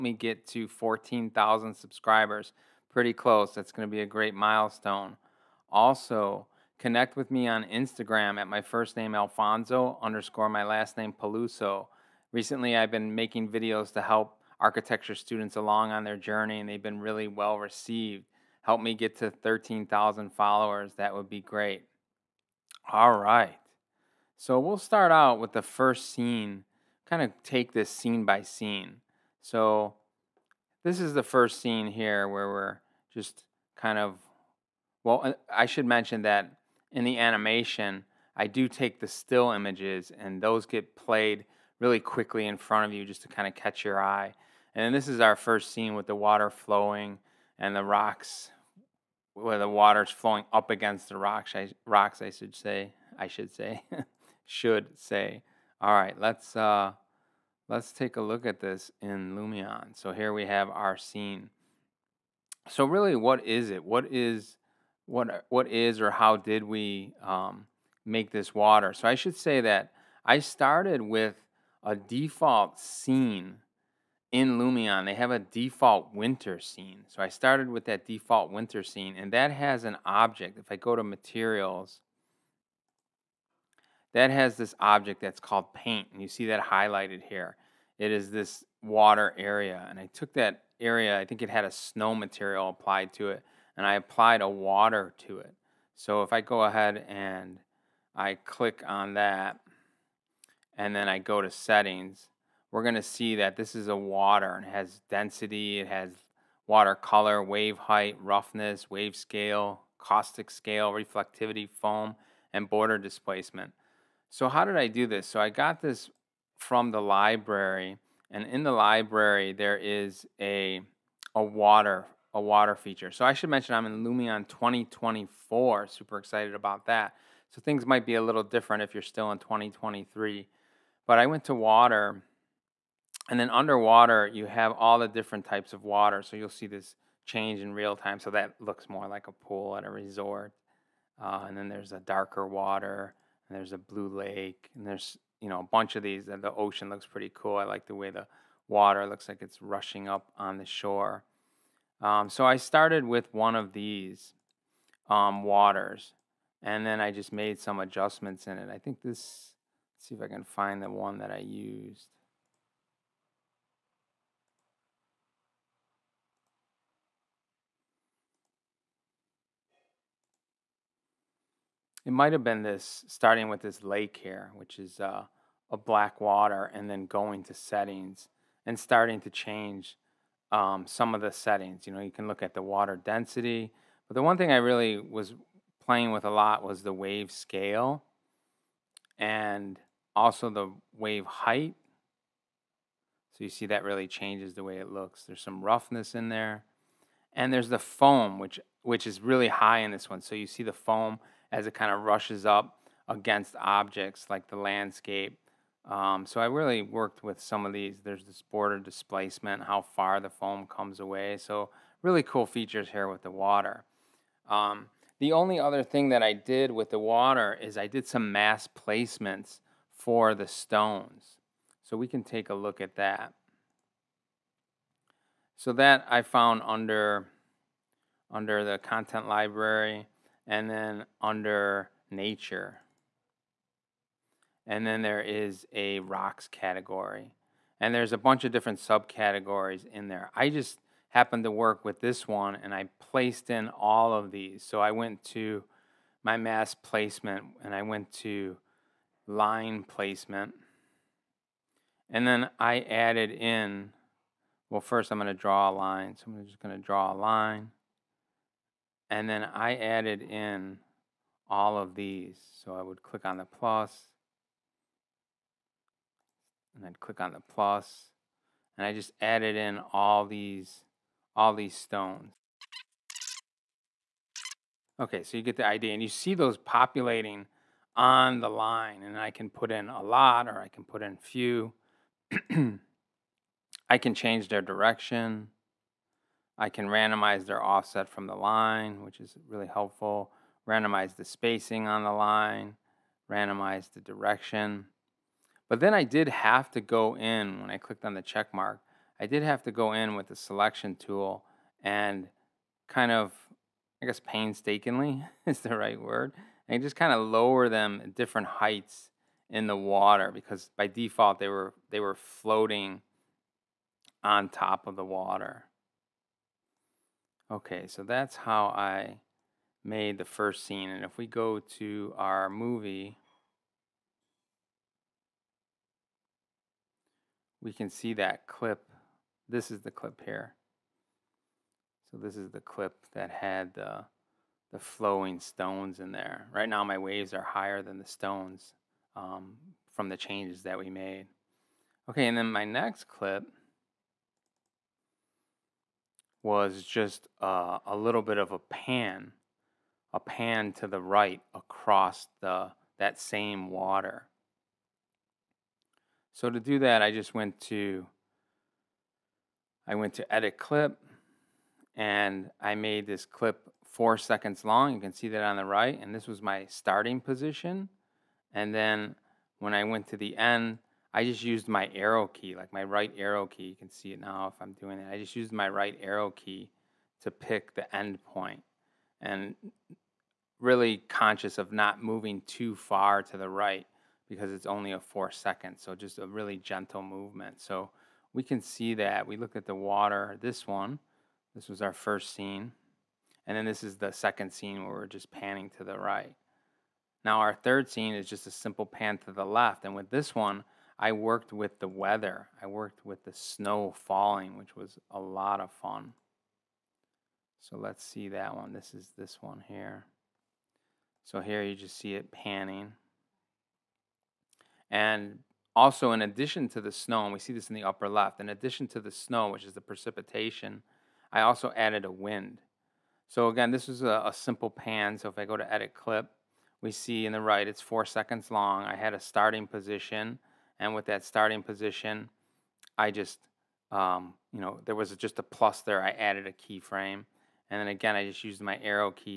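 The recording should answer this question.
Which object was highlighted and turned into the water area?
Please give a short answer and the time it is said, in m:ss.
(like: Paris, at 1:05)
paint, at 1:25.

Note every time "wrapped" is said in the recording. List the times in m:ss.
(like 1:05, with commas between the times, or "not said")
not said.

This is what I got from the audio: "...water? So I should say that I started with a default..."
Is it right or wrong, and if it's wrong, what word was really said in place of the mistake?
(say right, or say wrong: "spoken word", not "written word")
right.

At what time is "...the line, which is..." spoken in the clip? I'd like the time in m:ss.
4:48.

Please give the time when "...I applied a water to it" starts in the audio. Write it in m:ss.
1:33.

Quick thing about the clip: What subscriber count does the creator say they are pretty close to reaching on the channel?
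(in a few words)
14,000.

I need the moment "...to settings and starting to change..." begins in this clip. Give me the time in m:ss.
2:57.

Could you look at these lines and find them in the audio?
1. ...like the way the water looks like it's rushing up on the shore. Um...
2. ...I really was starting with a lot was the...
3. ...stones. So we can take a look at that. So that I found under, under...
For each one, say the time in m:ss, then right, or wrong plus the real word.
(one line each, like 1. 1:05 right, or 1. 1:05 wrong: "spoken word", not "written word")
1. 2:27 right
2. 3:04 wrong: "playing", not "starting"
3. 3:40 right.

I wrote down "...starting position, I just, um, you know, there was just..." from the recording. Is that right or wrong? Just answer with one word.
right.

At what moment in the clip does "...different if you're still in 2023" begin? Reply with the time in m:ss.
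2:08.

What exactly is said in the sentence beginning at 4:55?
But then I did have to go in when I clicked on the check mark.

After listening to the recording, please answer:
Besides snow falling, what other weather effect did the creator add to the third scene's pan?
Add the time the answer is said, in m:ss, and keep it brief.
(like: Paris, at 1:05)
wind, at 7:02.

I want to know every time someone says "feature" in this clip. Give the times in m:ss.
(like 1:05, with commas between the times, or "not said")
2:02, 3:32.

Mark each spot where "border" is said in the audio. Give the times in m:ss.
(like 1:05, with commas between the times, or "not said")
1:52, 3:28.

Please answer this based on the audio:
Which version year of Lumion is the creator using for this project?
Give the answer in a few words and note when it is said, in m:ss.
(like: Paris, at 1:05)
2024, at 2:04.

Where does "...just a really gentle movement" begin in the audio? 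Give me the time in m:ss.
6:25.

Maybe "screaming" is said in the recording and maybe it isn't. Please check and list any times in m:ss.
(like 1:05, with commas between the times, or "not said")
not said.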